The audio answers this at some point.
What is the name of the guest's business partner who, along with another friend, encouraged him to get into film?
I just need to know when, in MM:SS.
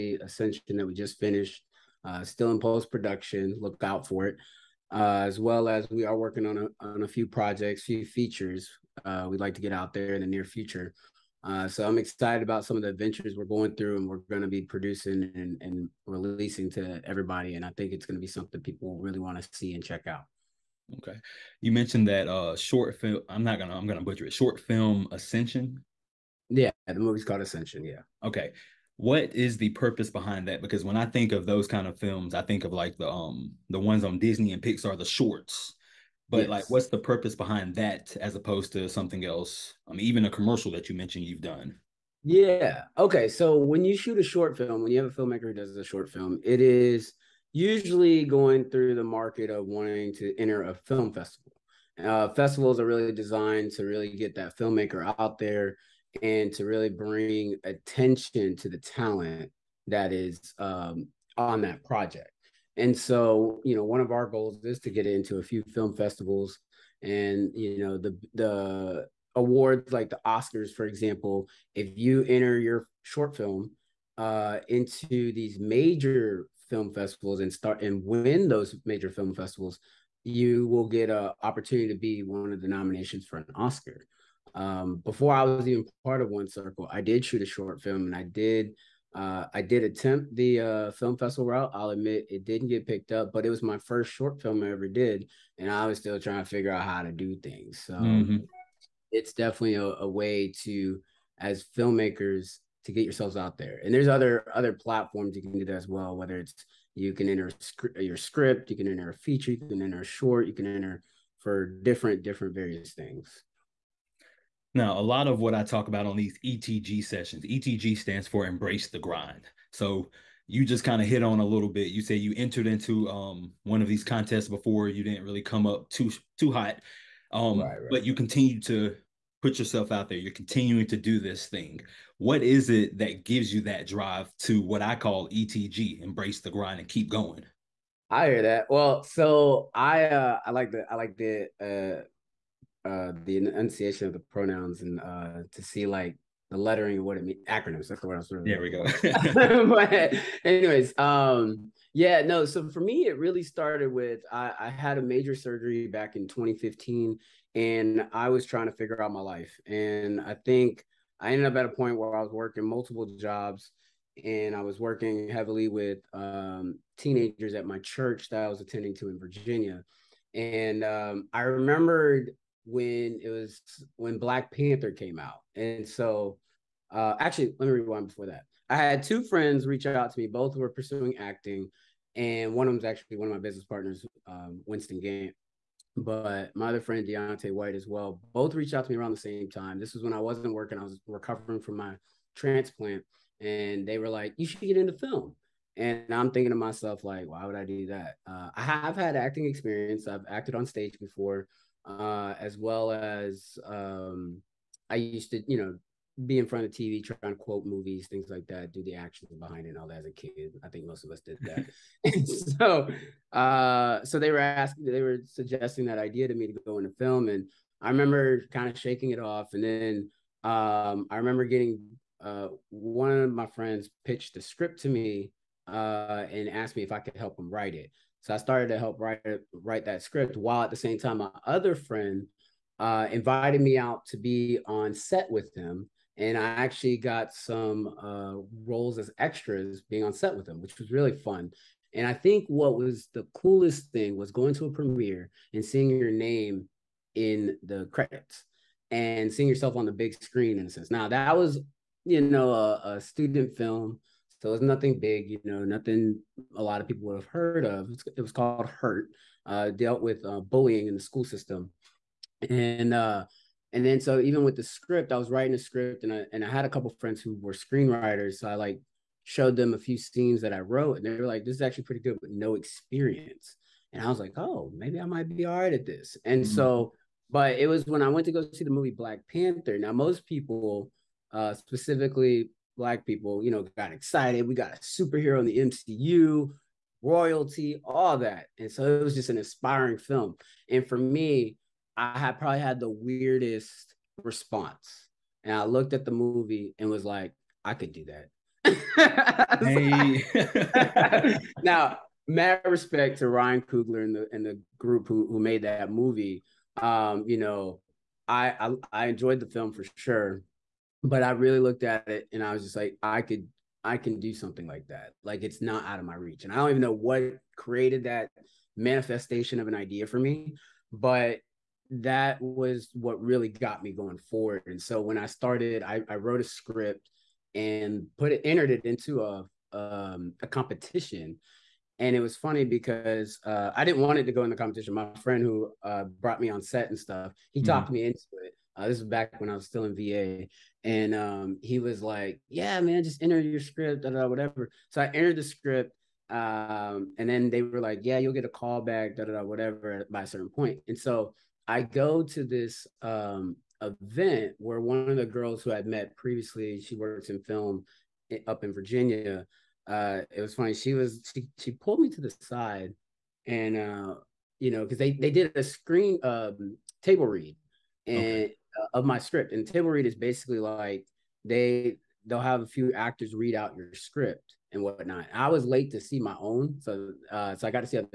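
03:04.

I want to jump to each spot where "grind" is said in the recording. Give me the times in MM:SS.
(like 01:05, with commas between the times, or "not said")
01:58, 02:16.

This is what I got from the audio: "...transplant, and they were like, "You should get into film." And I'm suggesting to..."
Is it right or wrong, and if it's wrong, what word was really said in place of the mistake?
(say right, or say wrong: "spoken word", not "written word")
wrong: "thinking", not "suggesting".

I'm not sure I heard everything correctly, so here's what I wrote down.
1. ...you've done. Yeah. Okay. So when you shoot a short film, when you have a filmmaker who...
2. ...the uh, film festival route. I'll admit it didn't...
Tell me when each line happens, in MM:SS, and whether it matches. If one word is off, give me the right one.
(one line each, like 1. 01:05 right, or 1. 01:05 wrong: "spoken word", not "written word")
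1. 00:41 right
2. 01:30 right.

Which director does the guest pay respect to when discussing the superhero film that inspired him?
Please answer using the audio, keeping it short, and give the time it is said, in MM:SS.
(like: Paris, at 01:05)
Ryan Coogler, at 05:03.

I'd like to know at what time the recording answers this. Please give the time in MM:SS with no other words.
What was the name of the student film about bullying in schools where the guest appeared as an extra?
04:18.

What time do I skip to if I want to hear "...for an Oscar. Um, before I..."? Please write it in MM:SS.
01:23.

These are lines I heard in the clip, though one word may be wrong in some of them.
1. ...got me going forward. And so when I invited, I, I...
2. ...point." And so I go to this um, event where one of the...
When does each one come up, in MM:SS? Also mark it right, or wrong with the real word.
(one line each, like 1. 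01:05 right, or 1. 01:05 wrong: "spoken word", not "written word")
1. 05:23 wrong: "started", not "invited"
2. 05:50 right.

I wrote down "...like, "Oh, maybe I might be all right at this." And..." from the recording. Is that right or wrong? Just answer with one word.
right.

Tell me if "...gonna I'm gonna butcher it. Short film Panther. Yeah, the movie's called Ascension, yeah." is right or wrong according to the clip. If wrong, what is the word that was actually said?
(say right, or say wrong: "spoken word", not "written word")
wrong: "Ascension", not "Panther".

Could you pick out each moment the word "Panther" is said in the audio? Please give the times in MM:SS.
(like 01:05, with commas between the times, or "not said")
02:54, 04:39.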